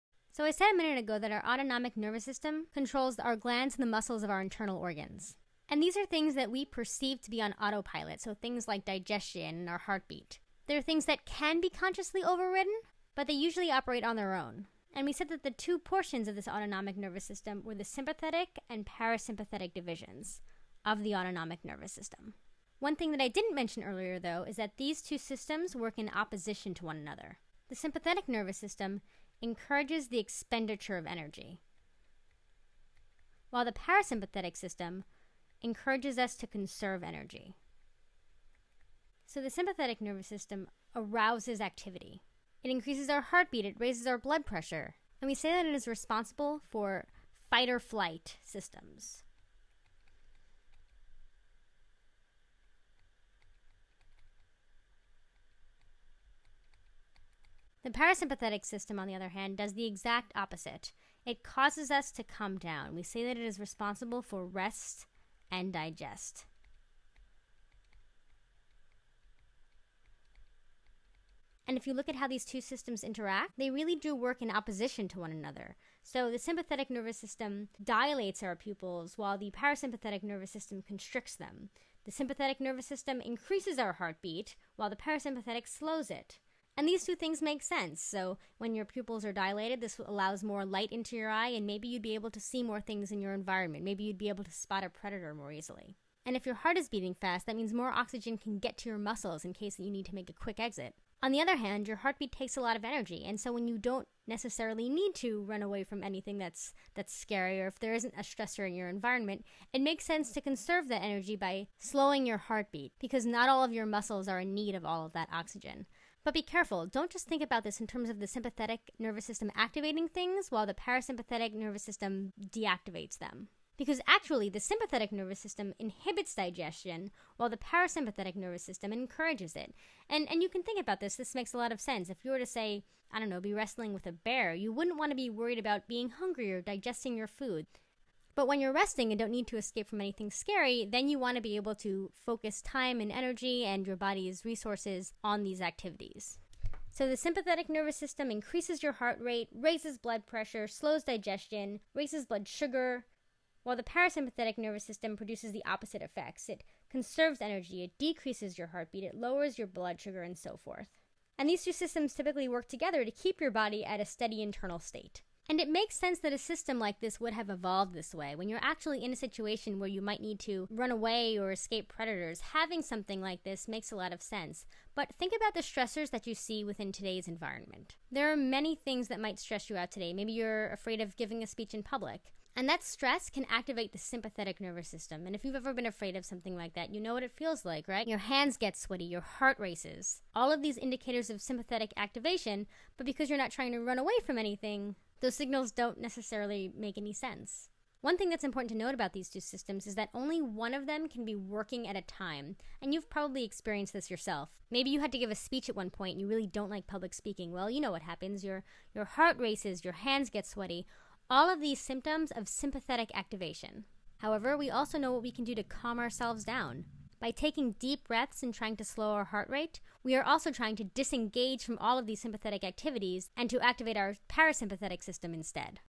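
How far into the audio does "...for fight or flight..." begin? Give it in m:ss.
0:46.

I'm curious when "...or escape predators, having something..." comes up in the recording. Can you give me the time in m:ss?
2:51.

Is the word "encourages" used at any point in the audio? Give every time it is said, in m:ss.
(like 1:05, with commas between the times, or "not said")
0:29, 0:35, 2:08.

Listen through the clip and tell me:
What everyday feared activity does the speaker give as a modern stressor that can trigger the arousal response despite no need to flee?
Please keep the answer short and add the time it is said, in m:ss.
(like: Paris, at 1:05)
giving a speech in public, at 3:01.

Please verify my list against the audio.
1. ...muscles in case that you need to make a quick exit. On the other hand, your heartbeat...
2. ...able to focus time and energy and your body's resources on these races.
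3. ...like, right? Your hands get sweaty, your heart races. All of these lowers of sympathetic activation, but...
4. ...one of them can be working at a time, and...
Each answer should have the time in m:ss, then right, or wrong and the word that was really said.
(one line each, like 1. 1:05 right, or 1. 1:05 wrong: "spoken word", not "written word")
1. 1:38 right
2. 2:21 wrong: "activities", not "races"
3. 3:07 wrong: "indicators", not "lowers"
4. 3:20 right.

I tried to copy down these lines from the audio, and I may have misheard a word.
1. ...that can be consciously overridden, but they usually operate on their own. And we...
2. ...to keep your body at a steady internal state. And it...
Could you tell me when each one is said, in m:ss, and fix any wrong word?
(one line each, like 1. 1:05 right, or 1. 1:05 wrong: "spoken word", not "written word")
1. 0:11 right
2. 2:43 right.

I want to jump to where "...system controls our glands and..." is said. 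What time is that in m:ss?
0:02.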